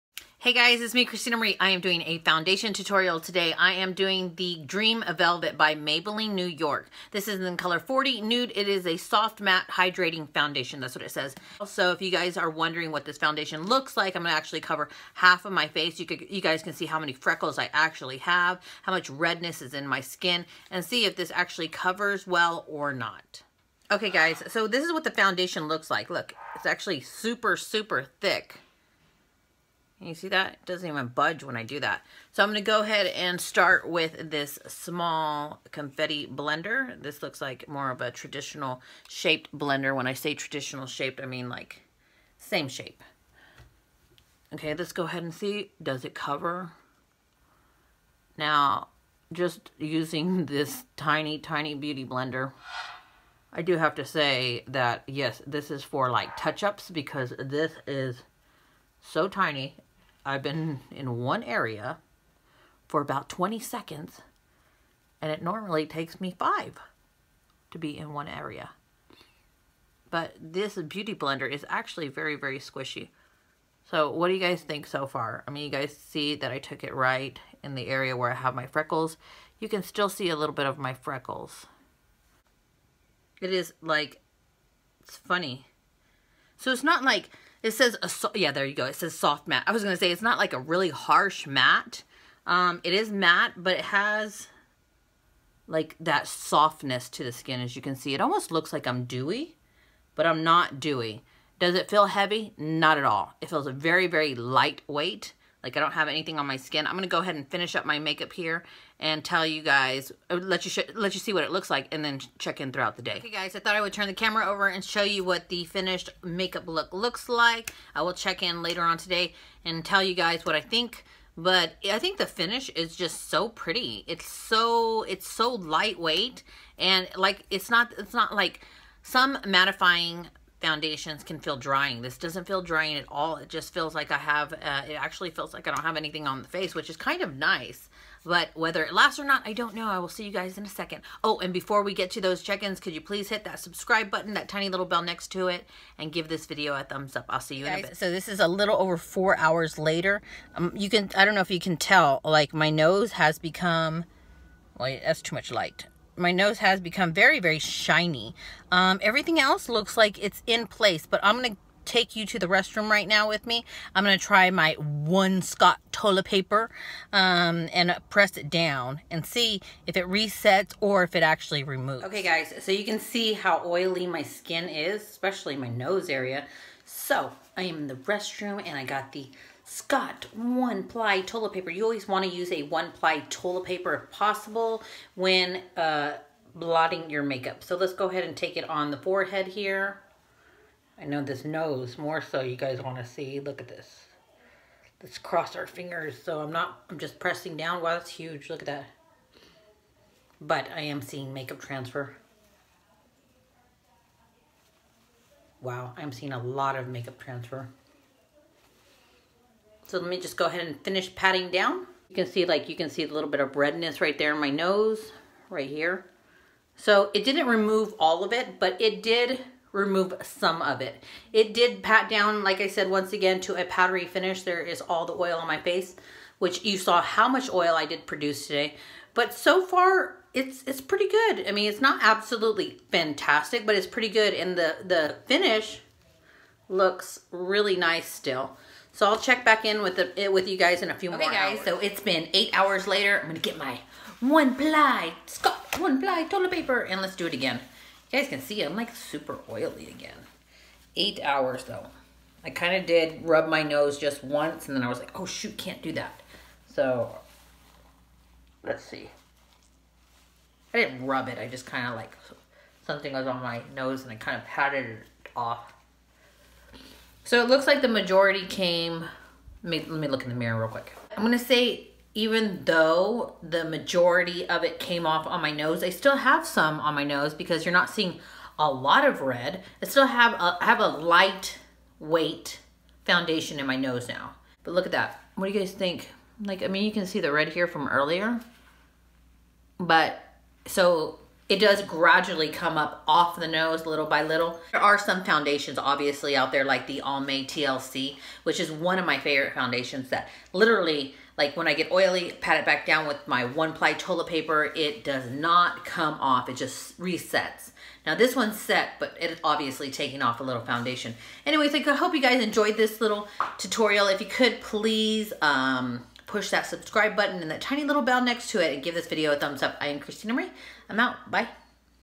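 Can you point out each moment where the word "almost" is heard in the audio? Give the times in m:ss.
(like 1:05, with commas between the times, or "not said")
1:38.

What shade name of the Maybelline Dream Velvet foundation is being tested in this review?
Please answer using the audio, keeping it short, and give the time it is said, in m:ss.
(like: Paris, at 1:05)
40 Nude, at 0:07.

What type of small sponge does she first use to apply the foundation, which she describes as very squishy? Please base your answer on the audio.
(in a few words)
confetti blender.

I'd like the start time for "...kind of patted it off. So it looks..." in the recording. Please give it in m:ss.
4:24.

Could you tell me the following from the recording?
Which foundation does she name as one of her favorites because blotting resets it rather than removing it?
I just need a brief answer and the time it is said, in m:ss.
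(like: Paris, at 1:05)
Almay TLC, at 4:57.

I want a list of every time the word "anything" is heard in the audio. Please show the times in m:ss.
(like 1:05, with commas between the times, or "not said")
1:46, 2:15.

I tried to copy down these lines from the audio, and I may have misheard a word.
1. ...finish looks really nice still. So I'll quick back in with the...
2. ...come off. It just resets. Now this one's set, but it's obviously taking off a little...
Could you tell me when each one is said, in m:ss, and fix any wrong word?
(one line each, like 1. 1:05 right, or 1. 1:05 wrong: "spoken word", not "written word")
1. 3:55 wrong: "check", not "quick"
2. 5:05 right.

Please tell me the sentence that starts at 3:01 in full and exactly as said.
You always want to use a one ply toilet paper if possible when uh, blotting your makeup.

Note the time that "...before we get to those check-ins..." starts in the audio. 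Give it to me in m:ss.
2:21.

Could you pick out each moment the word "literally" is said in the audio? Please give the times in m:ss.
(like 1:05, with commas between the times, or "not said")
5:00.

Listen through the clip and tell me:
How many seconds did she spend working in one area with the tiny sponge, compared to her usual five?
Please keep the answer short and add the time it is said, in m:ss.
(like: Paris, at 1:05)
20, at 1:03.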